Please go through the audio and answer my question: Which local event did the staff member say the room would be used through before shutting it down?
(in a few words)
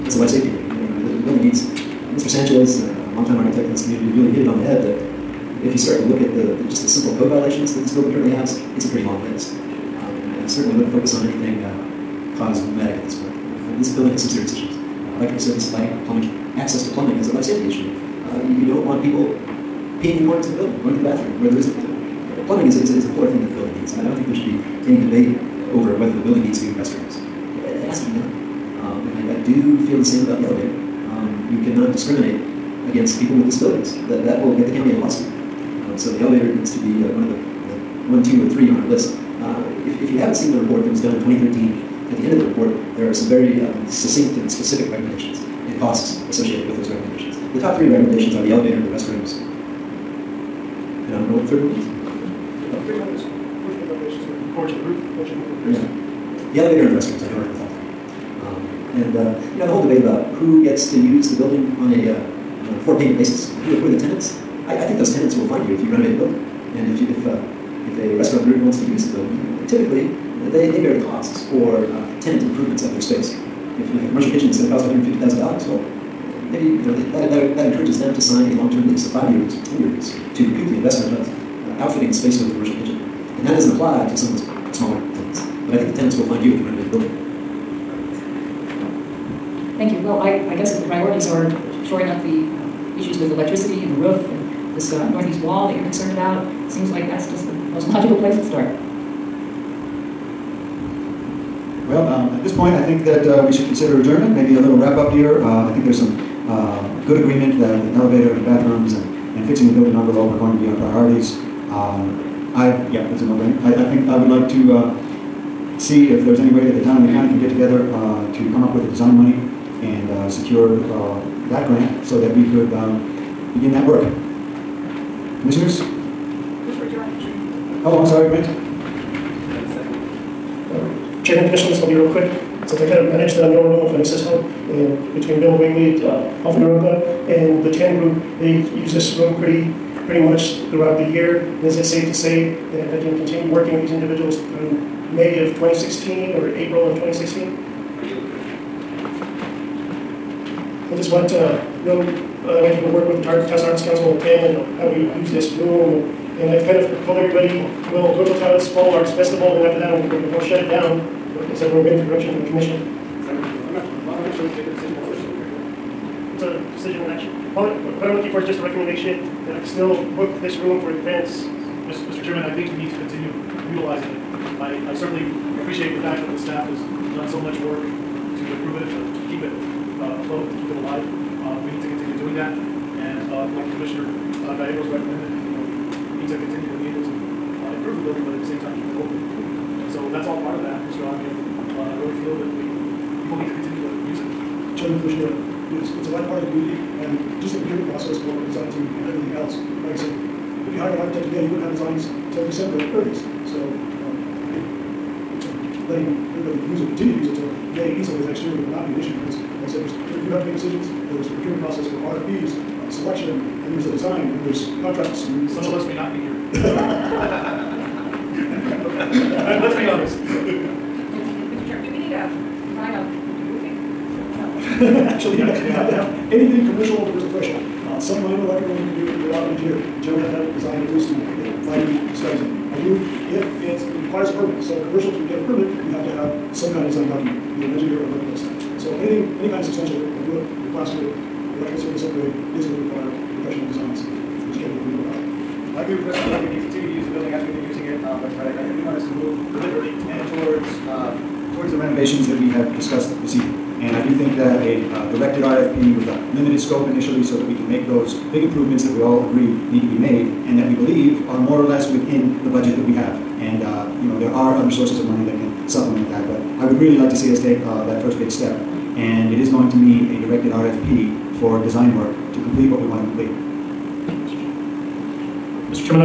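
Taos Fall Arts Festival.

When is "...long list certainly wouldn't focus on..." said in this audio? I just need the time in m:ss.
0:09.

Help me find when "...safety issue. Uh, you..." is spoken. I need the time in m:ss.
0:17.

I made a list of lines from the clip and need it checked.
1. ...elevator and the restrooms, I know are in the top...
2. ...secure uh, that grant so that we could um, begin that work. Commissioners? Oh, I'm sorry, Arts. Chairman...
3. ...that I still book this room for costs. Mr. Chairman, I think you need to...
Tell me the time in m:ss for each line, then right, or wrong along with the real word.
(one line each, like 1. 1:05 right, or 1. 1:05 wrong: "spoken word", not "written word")
1. 0:56 right
2. 2:00 wrong: "Brent", not "Arts"
3. 2:49 wrong: "events", not "costs".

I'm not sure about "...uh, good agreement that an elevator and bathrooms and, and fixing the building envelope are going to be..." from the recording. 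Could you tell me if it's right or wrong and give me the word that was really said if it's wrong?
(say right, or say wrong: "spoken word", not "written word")
right.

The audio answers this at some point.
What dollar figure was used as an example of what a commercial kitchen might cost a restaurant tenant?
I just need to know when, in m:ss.
1:14.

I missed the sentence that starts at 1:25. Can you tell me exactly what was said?
But I think the tenants will find you if you renovate the building.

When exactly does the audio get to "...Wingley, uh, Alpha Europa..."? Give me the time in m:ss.
2:15.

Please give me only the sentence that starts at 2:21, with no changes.
is it safe to say that I can continue working with these individuals through May of 2016 or April of 2016?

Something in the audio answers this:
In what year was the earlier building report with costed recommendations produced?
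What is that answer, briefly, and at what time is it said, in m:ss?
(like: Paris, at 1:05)
2013, at 0:41.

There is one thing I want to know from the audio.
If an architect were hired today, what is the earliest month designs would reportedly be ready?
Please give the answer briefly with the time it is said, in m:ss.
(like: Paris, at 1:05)
December, at 3:22.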